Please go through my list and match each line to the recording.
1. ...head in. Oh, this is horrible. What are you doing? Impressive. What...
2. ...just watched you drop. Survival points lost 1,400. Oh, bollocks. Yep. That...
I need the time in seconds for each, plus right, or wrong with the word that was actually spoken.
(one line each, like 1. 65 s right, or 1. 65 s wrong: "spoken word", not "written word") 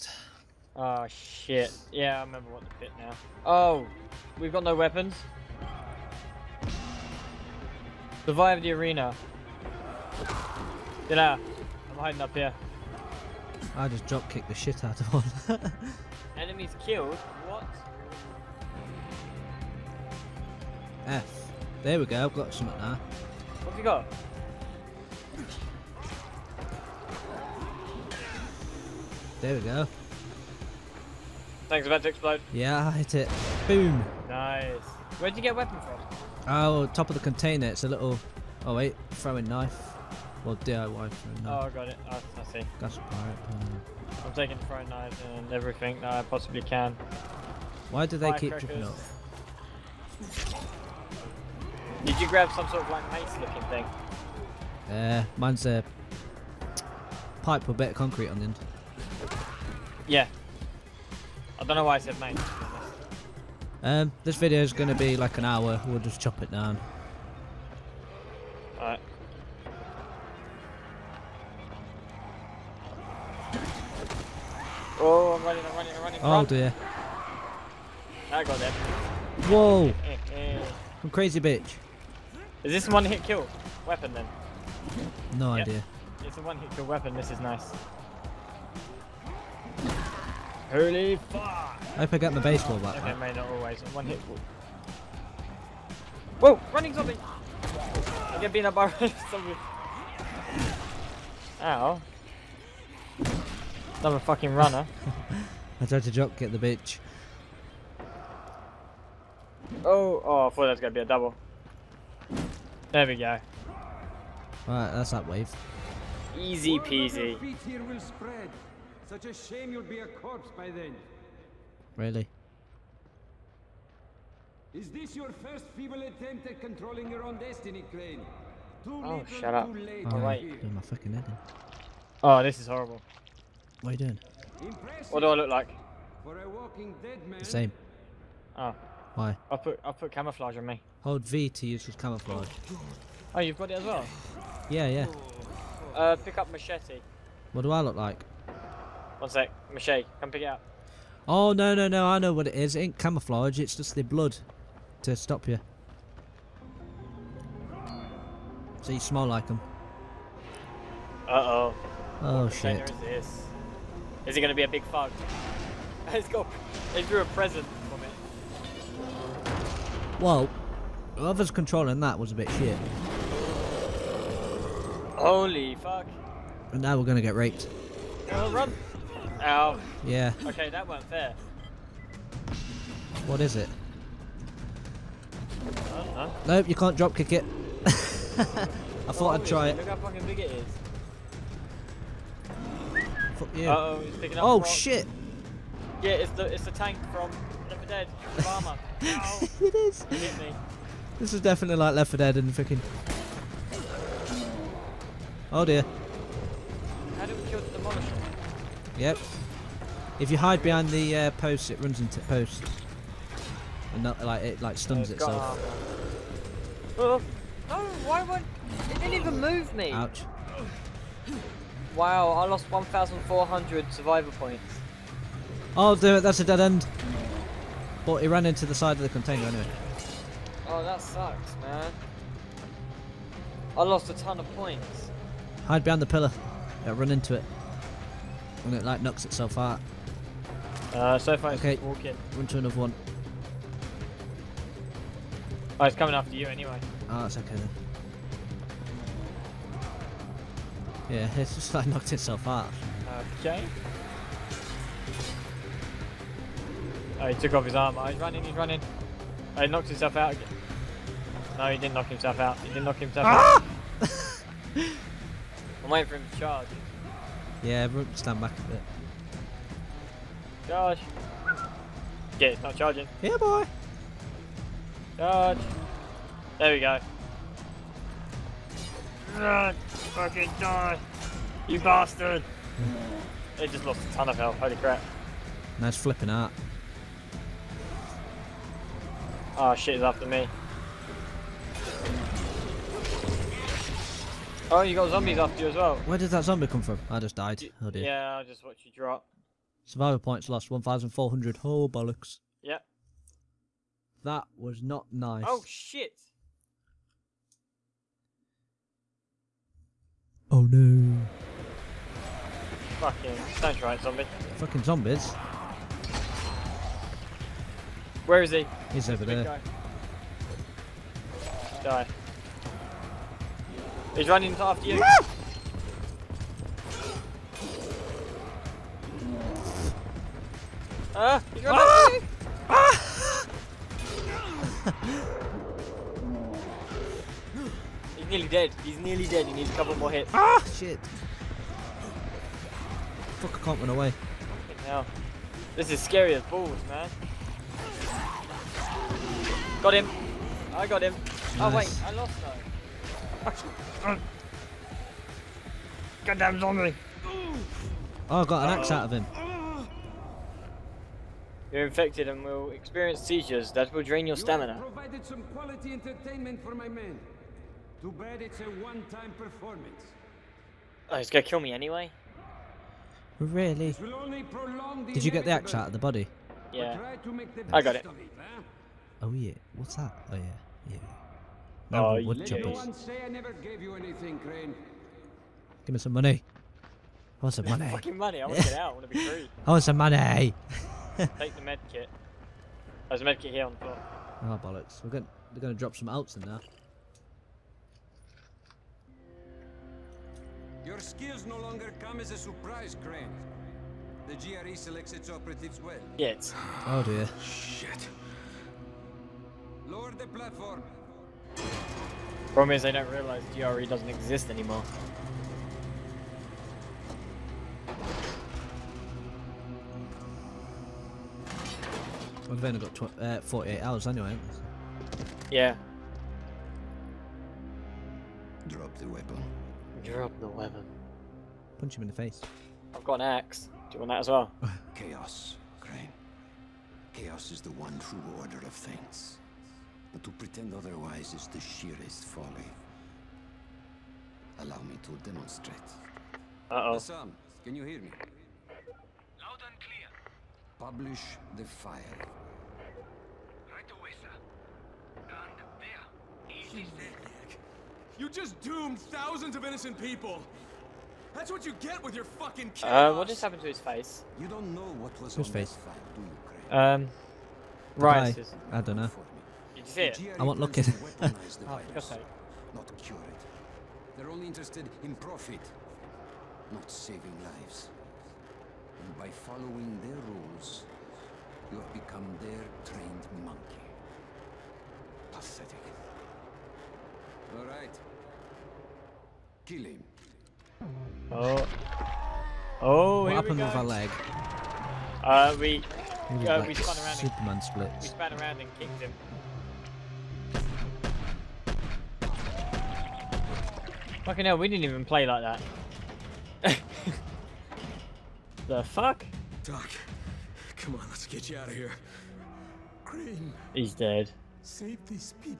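1. 131 s right
2. 298 s right.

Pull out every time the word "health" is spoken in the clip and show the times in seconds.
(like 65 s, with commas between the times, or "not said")
284 s.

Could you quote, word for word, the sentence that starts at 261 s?
No, he didn't knock himself out.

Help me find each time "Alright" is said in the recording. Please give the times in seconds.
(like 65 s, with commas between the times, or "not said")
68 s, 114 s, 129 s.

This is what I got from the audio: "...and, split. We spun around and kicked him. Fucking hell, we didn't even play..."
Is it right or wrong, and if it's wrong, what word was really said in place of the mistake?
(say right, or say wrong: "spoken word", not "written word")
right.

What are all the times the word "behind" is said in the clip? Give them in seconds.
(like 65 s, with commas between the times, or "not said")
210 s, 235 s.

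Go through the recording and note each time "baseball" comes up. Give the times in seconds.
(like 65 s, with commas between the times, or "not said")
92 s.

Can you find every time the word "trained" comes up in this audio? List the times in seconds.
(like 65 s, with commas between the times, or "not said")
482 s.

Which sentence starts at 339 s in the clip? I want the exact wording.
He needs a couple more hits.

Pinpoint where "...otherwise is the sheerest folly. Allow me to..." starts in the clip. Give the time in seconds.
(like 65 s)
440 s.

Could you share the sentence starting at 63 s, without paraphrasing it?
Um, this video is going to be like an hour.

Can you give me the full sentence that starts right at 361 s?
You're infected and will experience seizures that will drain your you stamina.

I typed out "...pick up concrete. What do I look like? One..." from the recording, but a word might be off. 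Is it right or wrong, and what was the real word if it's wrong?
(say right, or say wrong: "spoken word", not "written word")
wrong: "machete", not "concrete".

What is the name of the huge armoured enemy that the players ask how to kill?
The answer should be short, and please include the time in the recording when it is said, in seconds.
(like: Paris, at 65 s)
demolisher, at 207 s.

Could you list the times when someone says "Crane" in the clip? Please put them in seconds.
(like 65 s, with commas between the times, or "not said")
127 s, 403 s, 435 s, 513 s.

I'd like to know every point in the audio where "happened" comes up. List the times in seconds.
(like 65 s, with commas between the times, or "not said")
463 s, 493 s.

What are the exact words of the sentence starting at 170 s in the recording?
Well, whoever's controlling that was a bit shit.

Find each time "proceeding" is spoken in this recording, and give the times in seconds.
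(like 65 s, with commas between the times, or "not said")
not said.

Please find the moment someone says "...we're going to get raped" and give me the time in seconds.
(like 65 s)
176 s.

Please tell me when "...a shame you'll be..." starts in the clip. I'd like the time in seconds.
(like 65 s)
119 s.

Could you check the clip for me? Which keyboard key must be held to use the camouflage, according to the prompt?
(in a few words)
V.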